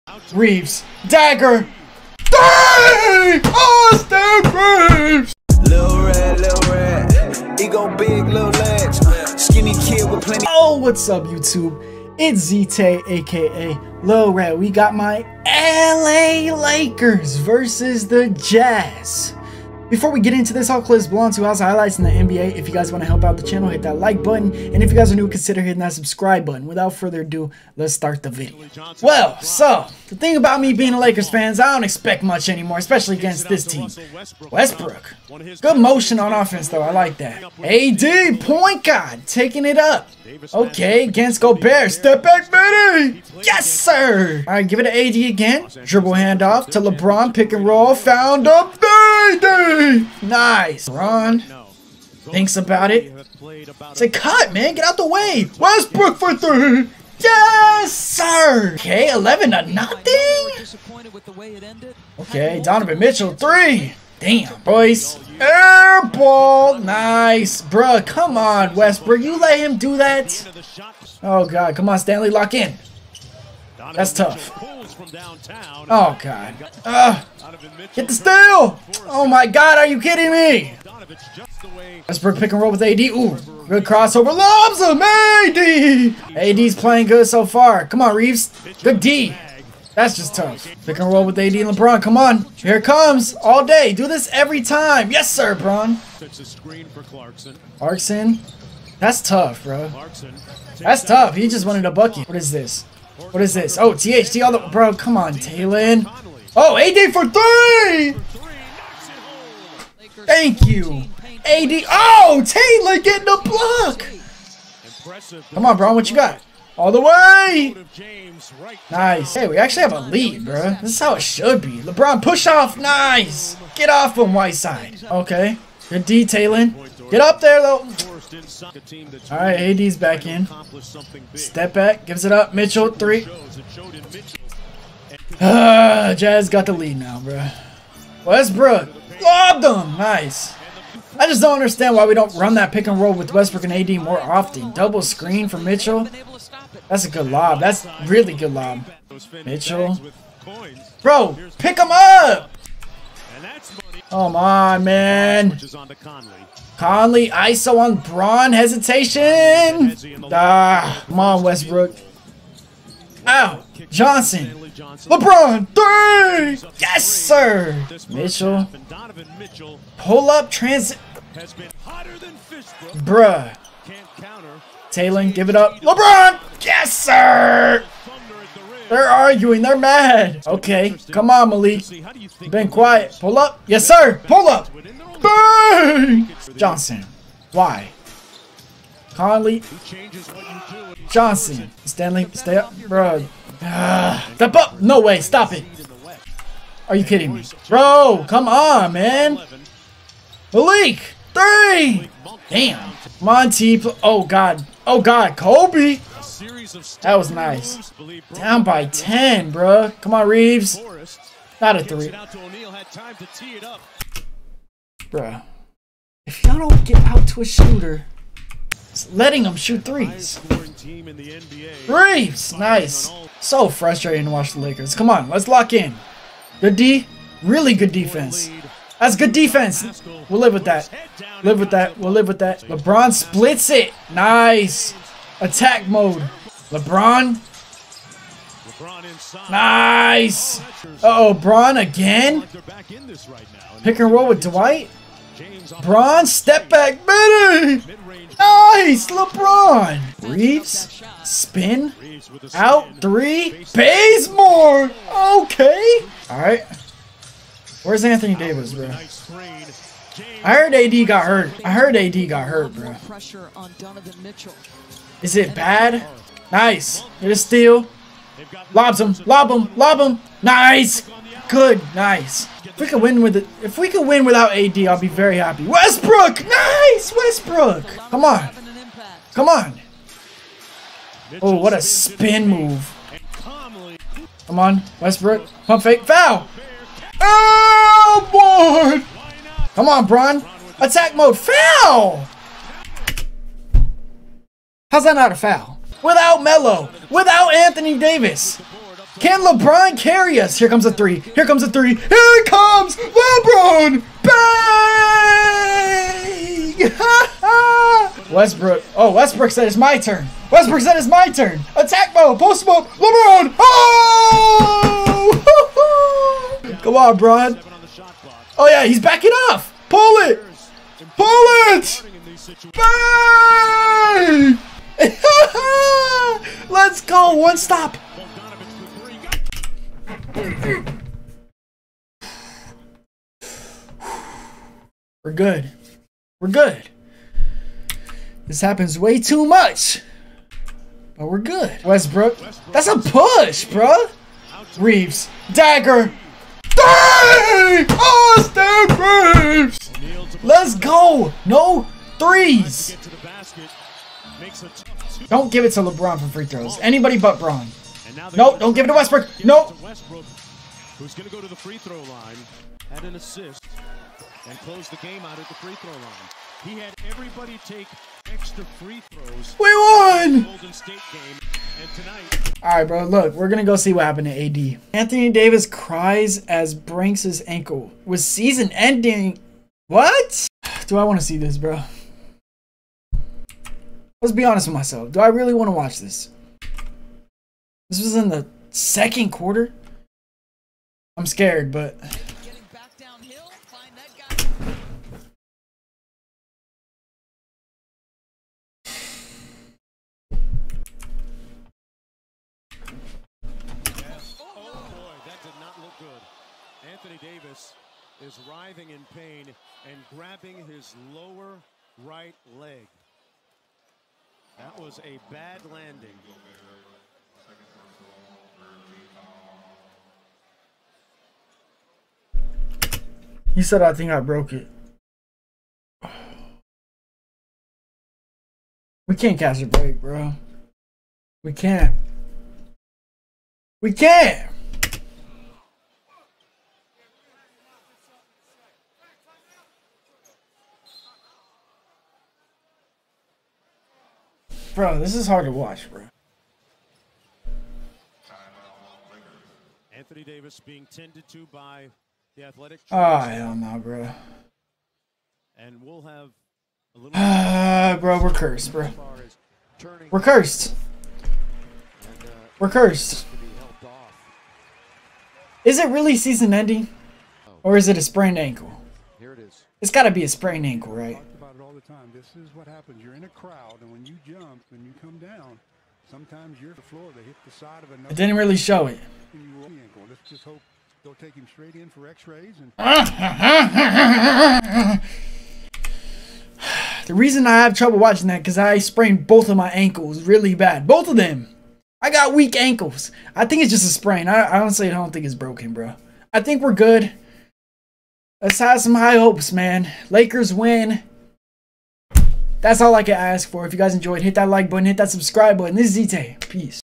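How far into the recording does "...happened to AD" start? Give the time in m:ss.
6:14.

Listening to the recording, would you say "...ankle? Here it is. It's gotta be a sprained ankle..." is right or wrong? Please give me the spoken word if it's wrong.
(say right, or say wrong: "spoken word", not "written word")
right.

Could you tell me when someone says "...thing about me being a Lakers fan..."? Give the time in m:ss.
0:30.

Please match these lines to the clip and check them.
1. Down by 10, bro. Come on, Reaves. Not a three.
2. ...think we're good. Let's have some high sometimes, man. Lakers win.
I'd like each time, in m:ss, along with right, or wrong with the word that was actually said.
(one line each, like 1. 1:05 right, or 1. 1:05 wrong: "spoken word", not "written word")
1. 3:28 right
2. 8:16 wrong: "hopes", not "sometimes".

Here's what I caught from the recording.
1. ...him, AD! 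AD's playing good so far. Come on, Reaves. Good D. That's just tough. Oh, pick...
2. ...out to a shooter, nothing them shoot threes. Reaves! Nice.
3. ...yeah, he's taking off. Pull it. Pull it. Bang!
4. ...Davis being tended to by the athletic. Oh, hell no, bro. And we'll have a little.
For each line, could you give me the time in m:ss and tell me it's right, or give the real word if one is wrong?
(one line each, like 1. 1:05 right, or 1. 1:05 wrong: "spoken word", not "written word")
1. 1:24 right
2. 3:37 wrong: "letting", not "nothing"
3. 5:18 wrong: "backing", not "taking"
4. 7:30 right.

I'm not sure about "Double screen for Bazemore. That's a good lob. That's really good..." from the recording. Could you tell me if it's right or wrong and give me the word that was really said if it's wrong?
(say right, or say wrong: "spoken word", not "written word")
wrong: "Mitchell", not "Bazemore".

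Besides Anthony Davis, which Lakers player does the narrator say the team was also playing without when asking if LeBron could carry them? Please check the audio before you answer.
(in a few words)
Melo.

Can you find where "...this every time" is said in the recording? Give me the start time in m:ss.
1:34.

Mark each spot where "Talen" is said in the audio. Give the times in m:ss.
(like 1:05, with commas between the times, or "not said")
1:45, 1:52.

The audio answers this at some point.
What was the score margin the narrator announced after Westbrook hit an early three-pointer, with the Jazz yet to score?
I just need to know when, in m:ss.
0:59.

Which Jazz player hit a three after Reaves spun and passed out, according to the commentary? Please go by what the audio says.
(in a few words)
Bazemore.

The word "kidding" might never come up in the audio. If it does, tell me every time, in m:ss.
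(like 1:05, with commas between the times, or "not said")
1:19, 3:17.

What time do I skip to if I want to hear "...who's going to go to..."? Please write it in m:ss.
6:00.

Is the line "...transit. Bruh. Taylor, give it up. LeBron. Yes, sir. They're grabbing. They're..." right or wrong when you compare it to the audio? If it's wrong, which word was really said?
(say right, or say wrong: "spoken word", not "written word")
wrong: "arguing", not "grabbing".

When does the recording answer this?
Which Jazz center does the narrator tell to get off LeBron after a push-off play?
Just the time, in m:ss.
2:04.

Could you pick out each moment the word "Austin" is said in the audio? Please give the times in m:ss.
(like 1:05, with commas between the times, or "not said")
0:03, 5:47.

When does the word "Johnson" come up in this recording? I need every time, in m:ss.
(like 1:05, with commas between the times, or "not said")
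2:43, 3:06, 3:11.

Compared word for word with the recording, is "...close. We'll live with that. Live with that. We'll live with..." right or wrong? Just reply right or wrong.
wrong.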